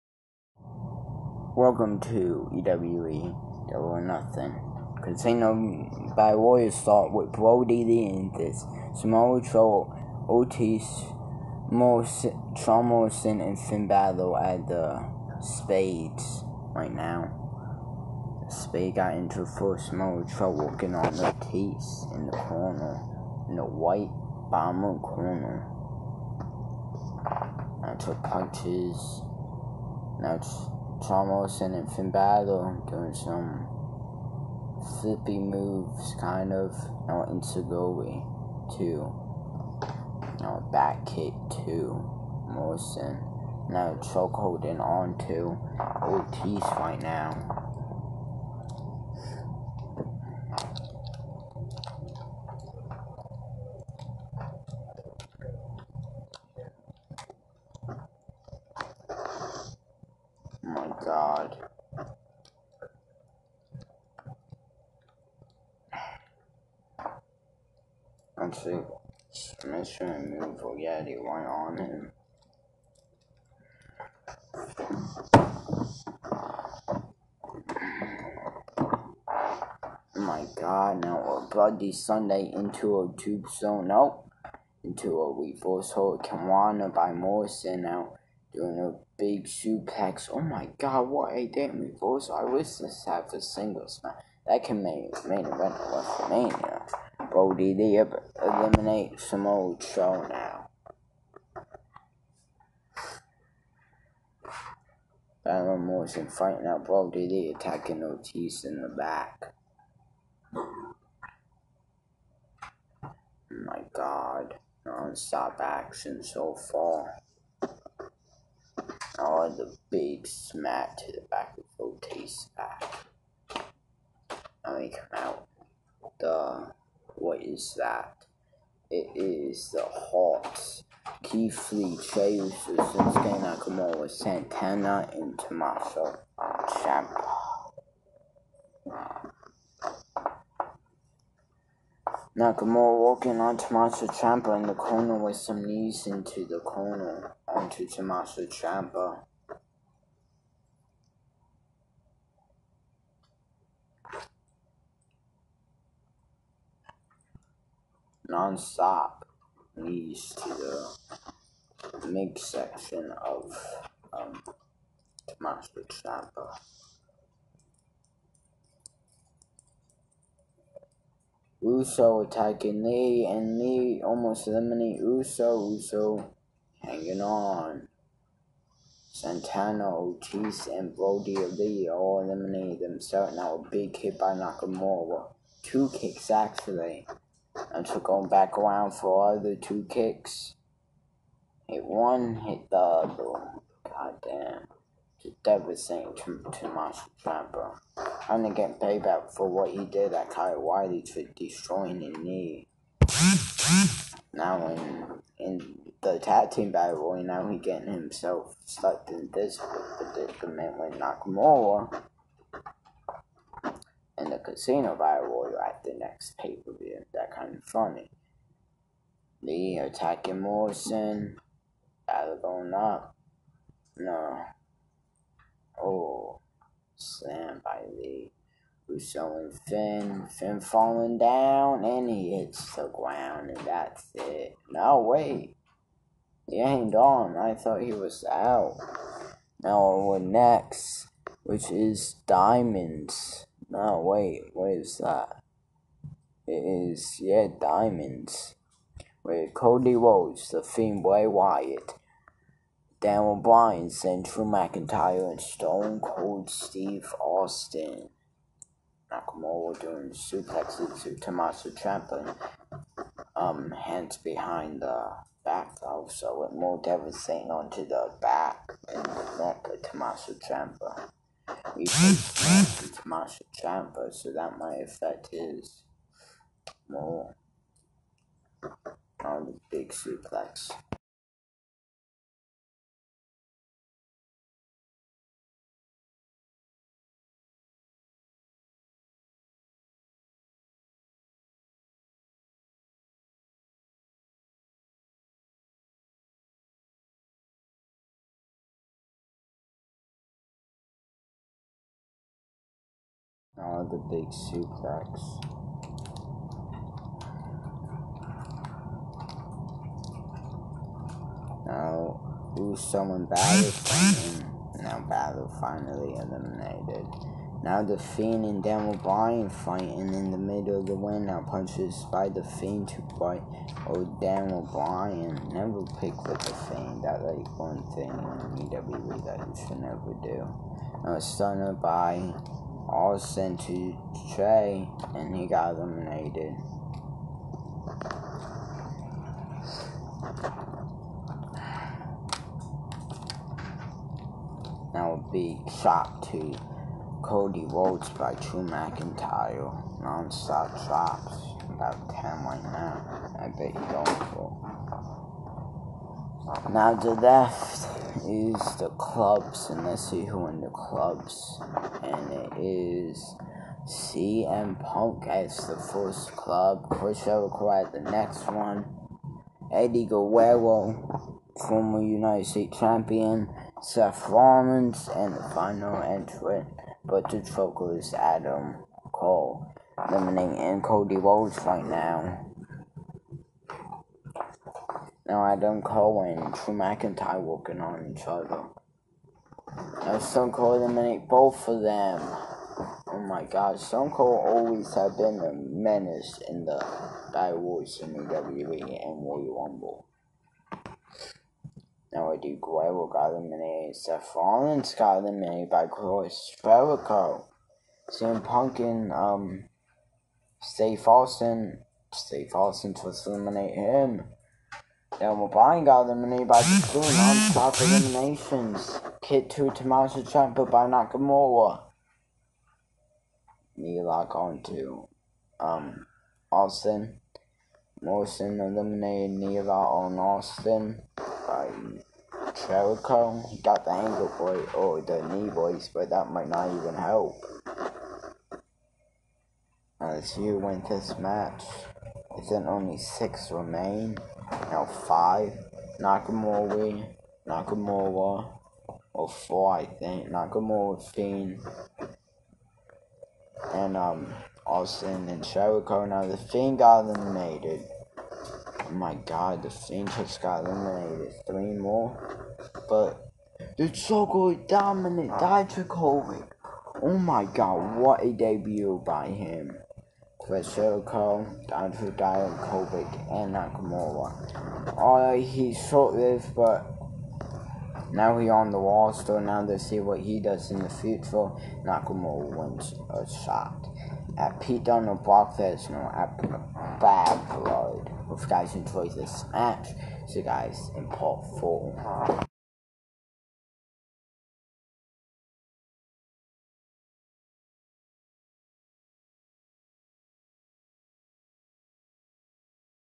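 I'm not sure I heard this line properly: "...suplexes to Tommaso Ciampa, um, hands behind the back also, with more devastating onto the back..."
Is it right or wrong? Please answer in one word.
right.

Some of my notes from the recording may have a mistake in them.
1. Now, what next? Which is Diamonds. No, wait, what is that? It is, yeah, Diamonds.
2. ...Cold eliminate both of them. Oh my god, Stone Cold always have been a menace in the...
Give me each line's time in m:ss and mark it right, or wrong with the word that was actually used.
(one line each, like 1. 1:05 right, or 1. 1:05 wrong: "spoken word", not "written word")
1. 3:59 right
2. 6:30 right.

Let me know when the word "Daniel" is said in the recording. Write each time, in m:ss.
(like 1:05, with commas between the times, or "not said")
4:12, 5:18, 5:24.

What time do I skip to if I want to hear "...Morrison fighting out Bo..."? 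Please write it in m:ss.
1:45.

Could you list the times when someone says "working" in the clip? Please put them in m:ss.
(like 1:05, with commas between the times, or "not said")
0:20, 6:27.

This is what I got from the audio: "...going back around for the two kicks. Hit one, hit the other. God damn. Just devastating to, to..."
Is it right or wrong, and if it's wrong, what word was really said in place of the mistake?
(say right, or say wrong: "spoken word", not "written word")
right.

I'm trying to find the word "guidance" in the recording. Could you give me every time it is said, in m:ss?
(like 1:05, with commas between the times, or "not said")
not said.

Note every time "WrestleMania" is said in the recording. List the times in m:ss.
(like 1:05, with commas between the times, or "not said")
1:35.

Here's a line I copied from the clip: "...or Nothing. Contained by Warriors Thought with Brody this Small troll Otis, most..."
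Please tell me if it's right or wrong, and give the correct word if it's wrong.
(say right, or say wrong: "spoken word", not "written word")
right.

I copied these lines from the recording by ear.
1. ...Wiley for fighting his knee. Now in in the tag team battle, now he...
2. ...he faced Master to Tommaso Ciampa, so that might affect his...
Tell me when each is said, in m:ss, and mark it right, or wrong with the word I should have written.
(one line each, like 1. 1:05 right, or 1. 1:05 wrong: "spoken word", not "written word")
1. 3:20 wrong: "destroying", not "fighting"
2. 4:31 right.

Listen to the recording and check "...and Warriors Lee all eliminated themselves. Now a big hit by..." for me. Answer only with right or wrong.
wrong.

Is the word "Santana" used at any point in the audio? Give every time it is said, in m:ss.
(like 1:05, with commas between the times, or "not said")
2:14, 2:59.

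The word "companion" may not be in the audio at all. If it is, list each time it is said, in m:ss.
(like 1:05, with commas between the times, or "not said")
not said.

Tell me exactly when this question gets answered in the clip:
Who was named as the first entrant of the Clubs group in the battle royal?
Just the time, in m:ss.
6:03.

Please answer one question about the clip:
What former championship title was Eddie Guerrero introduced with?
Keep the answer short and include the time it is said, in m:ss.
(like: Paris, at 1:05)
United States champion, at 6:12.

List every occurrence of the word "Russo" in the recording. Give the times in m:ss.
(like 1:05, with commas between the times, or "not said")
3:48.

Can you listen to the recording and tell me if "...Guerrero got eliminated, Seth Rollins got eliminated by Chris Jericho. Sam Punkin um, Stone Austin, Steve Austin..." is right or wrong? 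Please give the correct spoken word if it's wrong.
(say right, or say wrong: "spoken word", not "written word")
wrong: "Steve", not "Stone".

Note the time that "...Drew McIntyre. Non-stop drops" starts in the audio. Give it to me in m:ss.
5:48.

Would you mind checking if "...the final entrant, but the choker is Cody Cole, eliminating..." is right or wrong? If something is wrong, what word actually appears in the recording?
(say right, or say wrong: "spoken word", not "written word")
wrong: "Adam", not "Cody".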